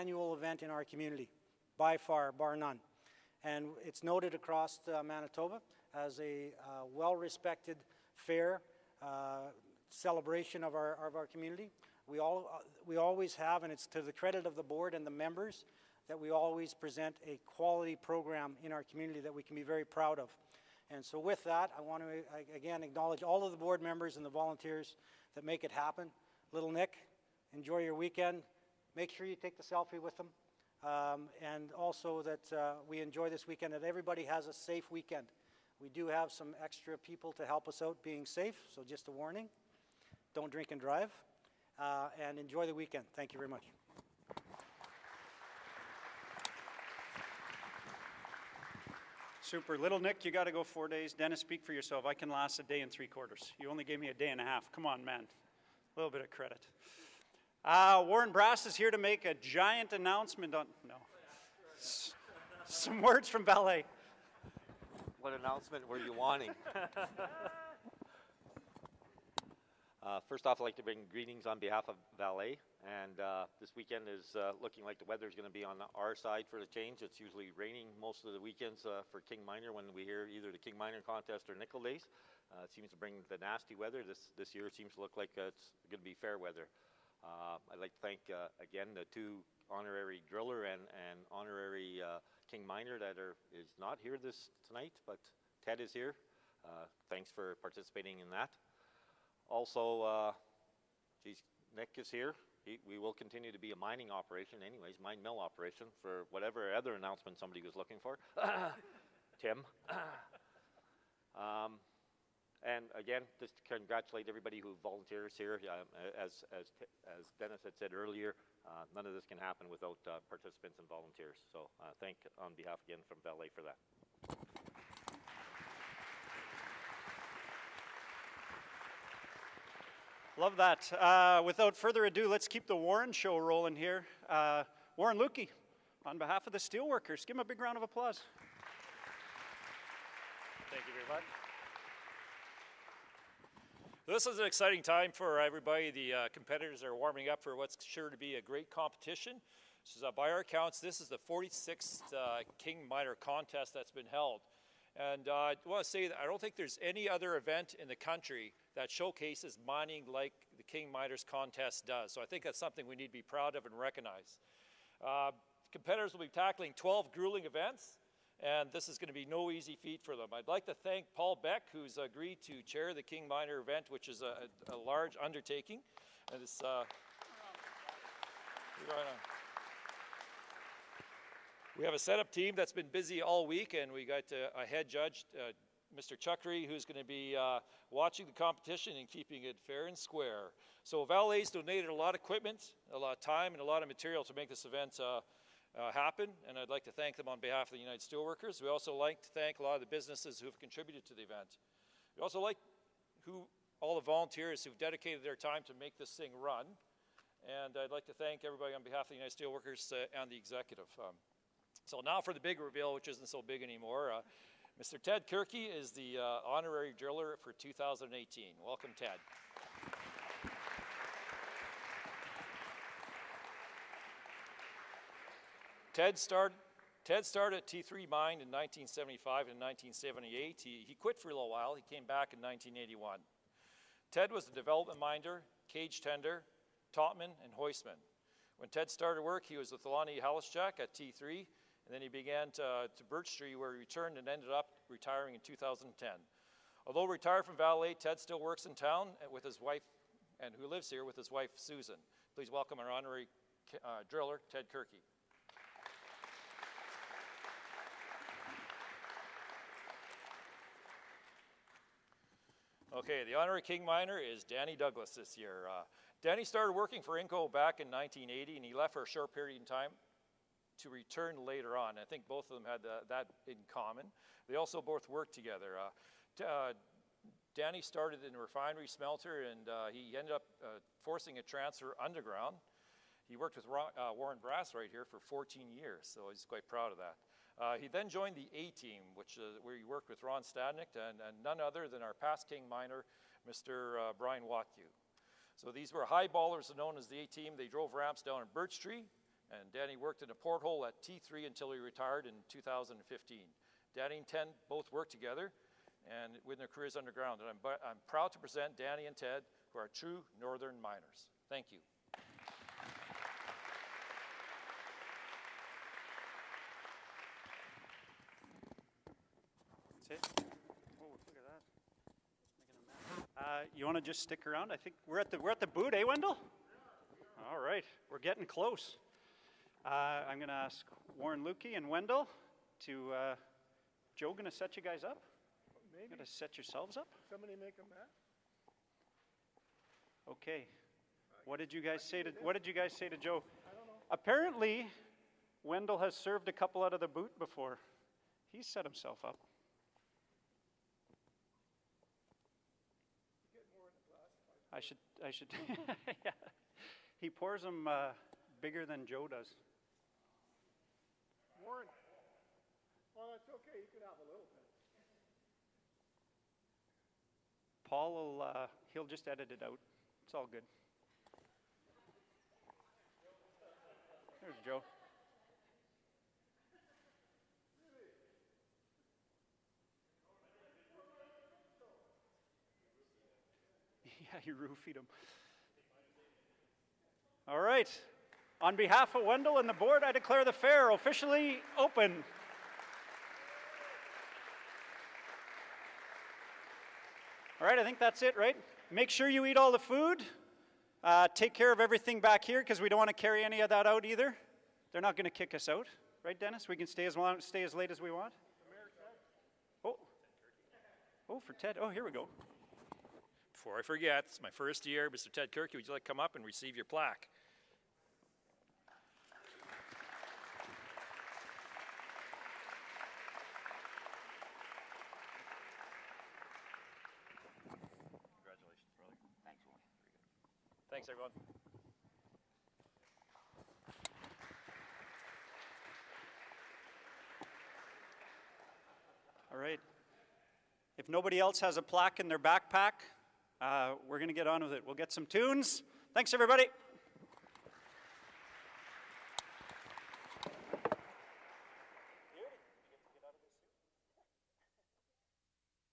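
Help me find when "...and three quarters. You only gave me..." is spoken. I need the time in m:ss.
0:52.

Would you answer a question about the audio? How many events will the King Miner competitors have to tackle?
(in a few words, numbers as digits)
12.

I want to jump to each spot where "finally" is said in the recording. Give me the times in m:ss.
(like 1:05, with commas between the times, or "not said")
not said.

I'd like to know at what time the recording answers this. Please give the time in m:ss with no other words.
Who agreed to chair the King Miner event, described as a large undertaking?
2:51.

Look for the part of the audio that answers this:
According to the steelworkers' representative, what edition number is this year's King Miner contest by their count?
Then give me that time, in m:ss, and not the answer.
2:31.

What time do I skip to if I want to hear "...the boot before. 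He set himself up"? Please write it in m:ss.
5:46.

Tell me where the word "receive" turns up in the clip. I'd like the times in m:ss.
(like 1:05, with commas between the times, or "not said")
6:56.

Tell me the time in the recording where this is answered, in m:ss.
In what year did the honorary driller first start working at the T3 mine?
3:48.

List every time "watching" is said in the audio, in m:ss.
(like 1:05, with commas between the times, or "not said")
3:07.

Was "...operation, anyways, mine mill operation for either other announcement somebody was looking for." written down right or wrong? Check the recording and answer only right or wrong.
wrong.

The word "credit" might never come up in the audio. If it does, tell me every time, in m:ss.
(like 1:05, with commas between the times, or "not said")
0:14, 0:56.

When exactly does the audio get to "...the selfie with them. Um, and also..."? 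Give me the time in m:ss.
0:29.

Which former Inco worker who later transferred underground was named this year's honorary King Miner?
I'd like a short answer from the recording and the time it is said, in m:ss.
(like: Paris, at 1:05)
Danny Douglas, at 4:24.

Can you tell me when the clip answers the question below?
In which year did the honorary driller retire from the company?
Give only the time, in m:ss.
4:05.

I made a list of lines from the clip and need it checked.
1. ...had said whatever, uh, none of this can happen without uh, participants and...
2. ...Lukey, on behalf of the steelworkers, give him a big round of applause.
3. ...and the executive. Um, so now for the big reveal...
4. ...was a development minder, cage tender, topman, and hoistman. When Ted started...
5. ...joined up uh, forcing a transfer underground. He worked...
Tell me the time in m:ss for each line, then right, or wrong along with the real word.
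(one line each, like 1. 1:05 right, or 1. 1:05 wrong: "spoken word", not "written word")
1. 1:57 wrong: "earlier", not "whatever"
2. 2:15 right
3. 3:30 right
4. 3:54 right
5. 4:40 wrong: "ended", not "joined".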